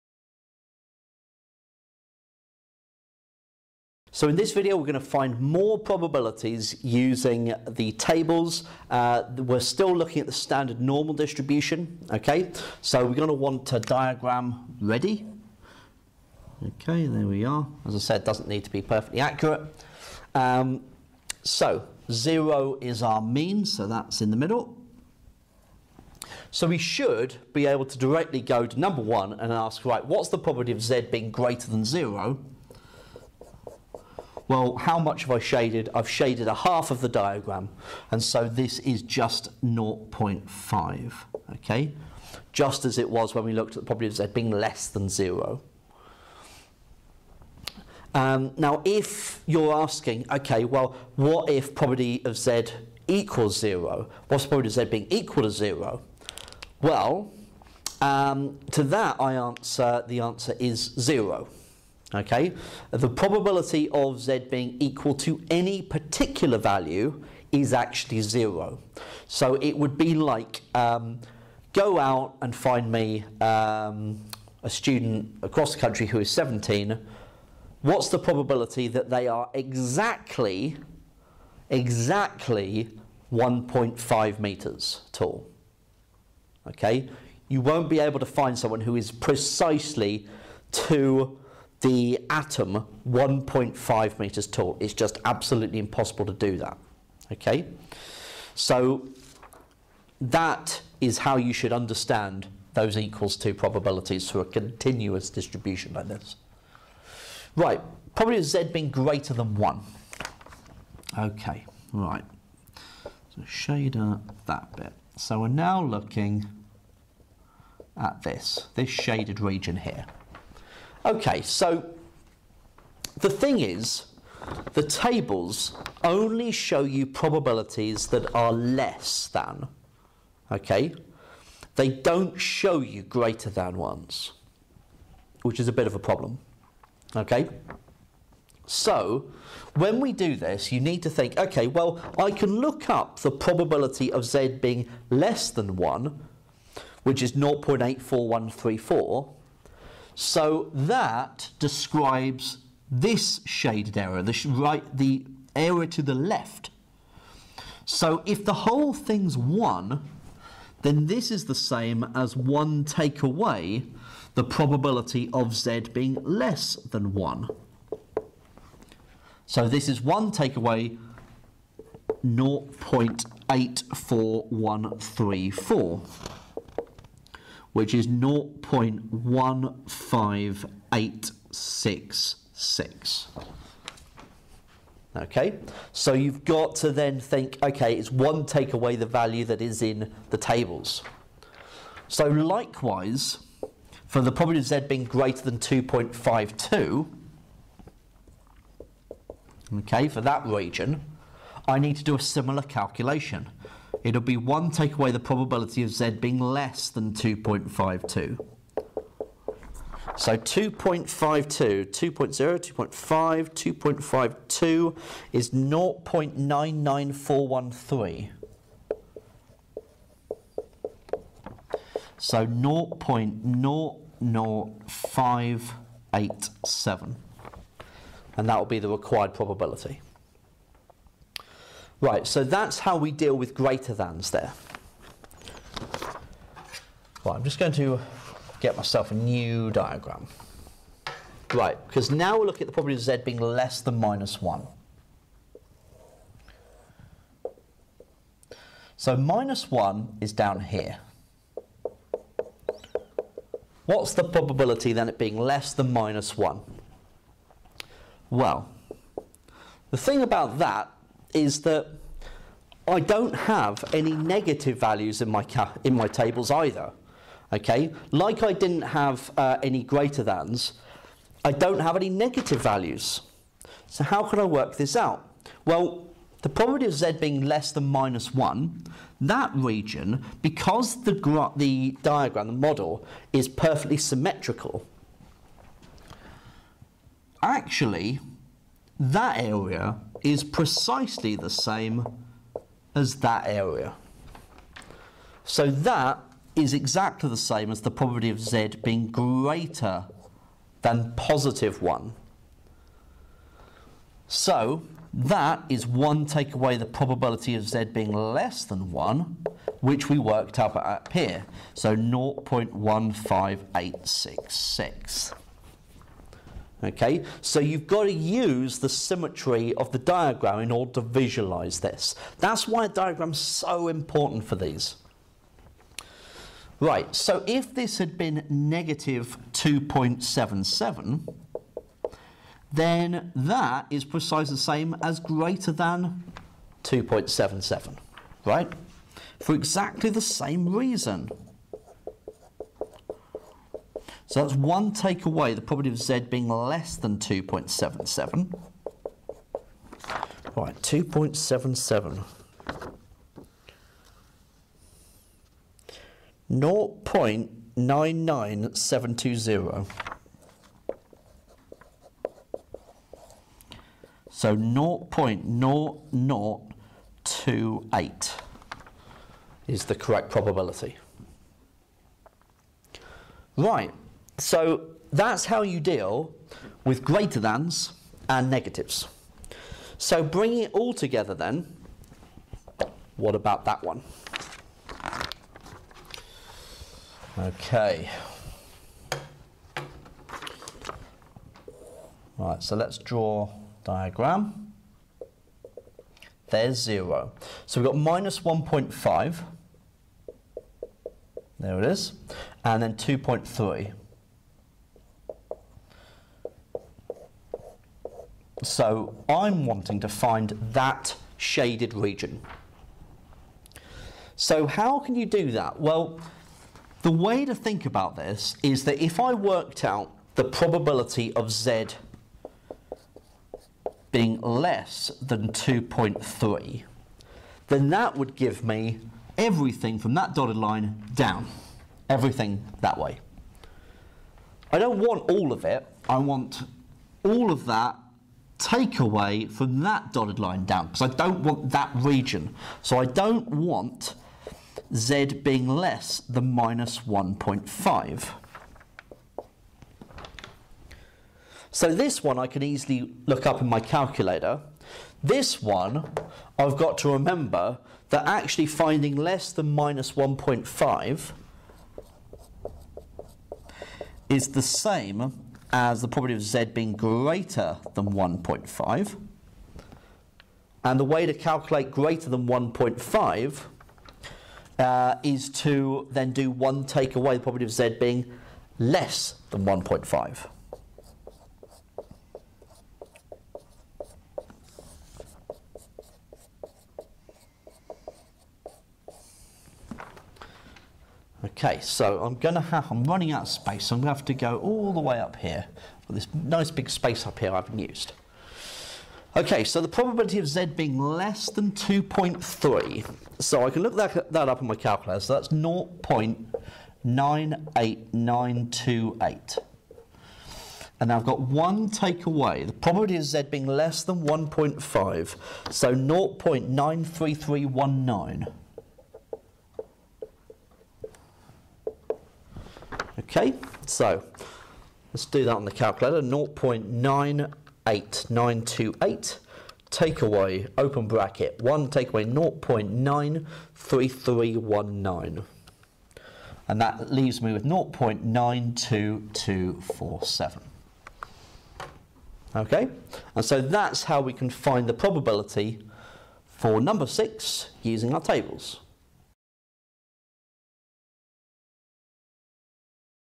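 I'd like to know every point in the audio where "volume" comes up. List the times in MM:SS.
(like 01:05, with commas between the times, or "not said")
not said.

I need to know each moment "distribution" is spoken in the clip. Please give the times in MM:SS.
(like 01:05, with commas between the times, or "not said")
00:11, 01:45.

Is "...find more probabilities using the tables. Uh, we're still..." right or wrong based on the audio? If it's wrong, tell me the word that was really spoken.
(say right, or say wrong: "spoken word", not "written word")
right.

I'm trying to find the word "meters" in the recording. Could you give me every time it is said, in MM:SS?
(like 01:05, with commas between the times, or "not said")
01:24, 01:34.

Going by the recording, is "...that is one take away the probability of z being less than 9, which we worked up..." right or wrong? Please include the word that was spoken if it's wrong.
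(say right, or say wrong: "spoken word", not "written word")
wrong: "1", not "9".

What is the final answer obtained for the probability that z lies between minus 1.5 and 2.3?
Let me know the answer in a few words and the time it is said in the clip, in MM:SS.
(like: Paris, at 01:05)
0.92247, at 08:57.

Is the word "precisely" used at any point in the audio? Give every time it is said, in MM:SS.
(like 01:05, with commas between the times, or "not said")
01:29, 04:50, 05:34.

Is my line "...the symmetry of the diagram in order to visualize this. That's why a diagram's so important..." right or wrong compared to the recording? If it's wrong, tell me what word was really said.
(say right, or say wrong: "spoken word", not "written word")
right.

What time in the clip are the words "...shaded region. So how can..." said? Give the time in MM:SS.
06:51.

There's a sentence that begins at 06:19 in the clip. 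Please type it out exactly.
So bringing it all together then, what about that one?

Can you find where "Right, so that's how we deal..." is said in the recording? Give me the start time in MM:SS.
03:52.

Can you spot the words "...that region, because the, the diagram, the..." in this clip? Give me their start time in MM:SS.
04:39.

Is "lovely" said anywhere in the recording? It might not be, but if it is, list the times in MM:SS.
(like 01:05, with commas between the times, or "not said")
not said.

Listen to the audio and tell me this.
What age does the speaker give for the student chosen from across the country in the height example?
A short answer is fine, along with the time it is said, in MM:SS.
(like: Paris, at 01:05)
17, at 01:16.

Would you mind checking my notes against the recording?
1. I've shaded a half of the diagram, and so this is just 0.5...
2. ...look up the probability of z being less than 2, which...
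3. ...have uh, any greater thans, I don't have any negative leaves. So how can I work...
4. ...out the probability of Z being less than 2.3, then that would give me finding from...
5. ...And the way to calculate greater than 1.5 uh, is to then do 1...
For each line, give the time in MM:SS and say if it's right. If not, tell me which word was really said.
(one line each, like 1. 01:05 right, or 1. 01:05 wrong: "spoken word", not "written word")
1. 00:35 right
2. 02:22 wrong: "1", not "2"
3. 04:28 wrong: "values", not "leaves"
4. 06:59 wrong: "everything", not "finding"
5. 07:50 right.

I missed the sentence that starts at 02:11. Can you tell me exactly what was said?
They don't show you greater than ones, which is a bit of a problem, okay?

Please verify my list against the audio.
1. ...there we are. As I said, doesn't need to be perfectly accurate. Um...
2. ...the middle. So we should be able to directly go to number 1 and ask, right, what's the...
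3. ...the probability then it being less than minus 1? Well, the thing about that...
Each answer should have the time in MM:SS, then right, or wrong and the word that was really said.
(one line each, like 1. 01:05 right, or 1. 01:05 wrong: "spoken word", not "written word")
1. 00:17 right
2. 00:24 right
3. 04:14 right.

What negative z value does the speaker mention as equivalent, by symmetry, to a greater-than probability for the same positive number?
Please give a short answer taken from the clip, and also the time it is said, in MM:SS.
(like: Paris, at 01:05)
-2.77, at 05:28.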